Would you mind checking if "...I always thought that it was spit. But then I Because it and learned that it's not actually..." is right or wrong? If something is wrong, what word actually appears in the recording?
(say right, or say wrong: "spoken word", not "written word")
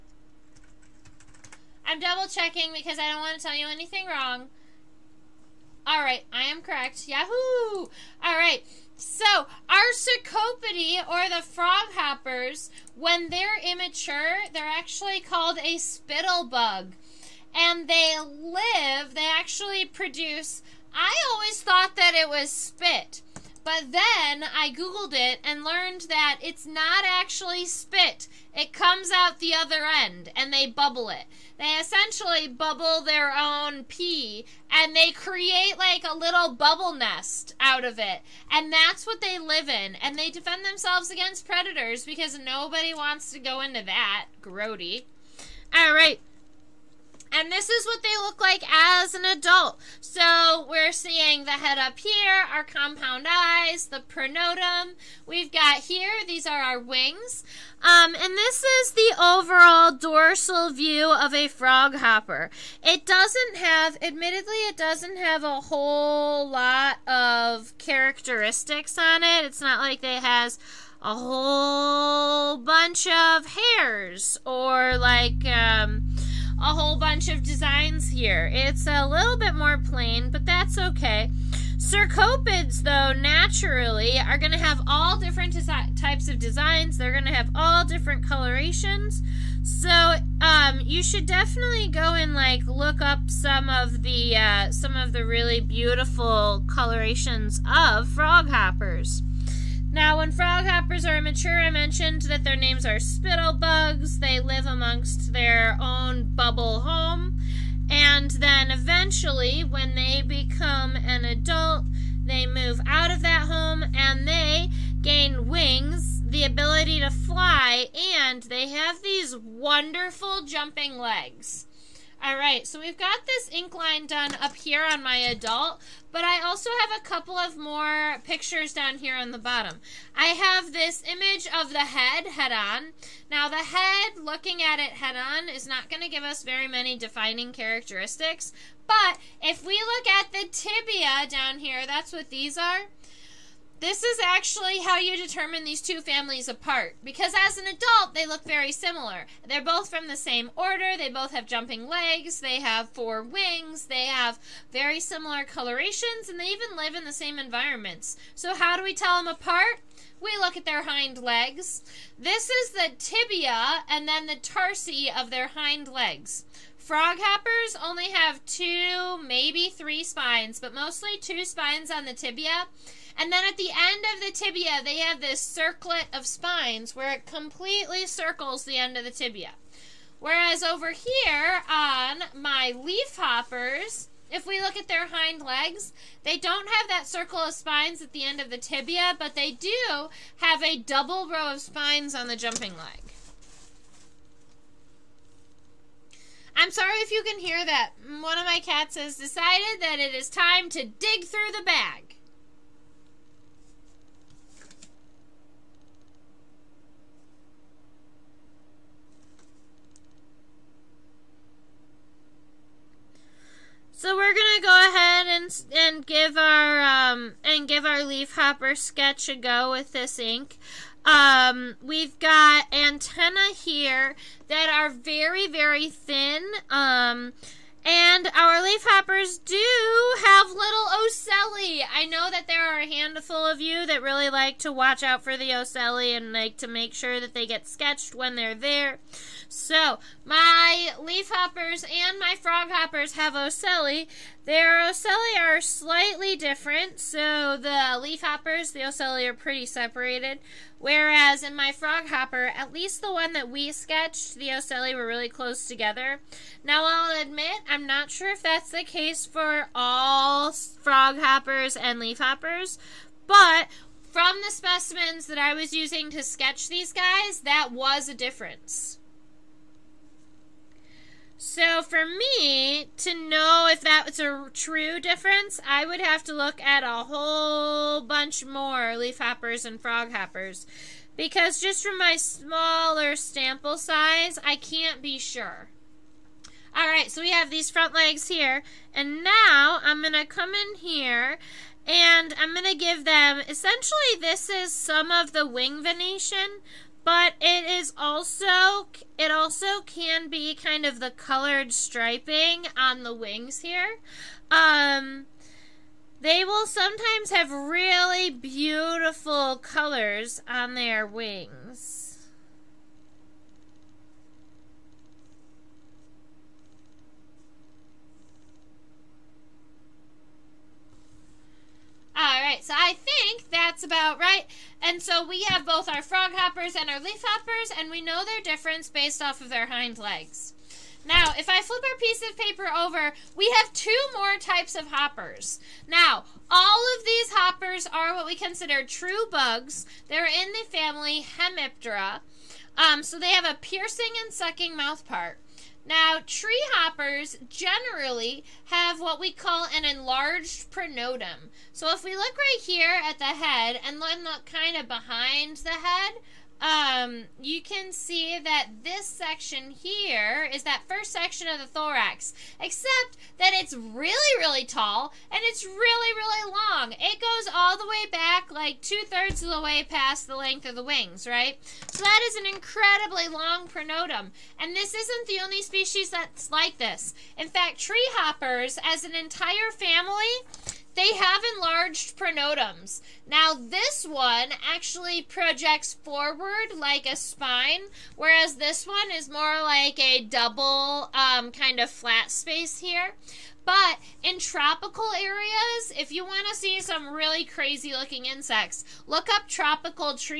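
wrong: "Googled", not "Because".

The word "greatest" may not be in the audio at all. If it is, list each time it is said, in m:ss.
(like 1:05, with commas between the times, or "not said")
not said.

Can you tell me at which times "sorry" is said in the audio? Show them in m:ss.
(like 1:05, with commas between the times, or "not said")
3:16.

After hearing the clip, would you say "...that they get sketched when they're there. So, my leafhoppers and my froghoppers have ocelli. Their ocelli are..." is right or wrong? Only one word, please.
right.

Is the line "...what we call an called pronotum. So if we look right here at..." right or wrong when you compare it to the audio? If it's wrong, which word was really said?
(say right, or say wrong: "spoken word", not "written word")
wrong: "enlarged", not "called".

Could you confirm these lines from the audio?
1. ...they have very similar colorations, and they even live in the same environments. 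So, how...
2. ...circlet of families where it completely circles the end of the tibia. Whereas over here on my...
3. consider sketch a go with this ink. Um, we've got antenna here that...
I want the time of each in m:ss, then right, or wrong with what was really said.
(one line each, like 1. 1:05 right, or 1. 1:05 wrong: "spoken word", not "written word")
1. 2:33 right
2. 2:55 wrong: "spines", not "families"
3. 3:38 wrong: "copper", not "consider".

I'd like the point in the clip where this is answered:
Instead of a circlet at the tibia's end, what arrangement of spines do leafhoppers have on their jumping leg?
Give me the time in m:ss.
3:10.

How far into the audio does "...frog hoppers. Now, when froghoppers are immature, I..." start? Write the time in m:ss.
1:38.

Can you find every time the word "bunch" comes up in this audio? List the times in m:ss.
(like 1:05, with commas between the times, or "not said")
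1:12, 1:16, 4:38.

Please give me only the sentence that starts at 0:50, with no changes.
So we're seeing the head up here, our compound eyes, the pronotum.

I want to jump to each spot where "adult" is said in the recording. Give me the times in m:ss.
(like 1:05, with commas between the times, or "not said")
0:49, 1:51, 2:05, 2:27.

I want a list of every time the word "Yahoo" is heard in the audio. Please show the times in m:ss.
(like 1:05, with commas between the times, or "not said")
0:07.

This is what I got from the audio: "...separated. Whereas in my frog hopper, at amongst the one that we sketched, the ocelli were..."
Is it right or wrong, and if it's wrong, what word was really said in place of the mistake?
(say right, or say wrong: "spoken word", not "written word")
wrong: "least", not "amongst".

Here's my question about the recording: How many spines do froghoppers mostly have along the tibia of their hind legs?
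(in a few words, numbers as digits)
2.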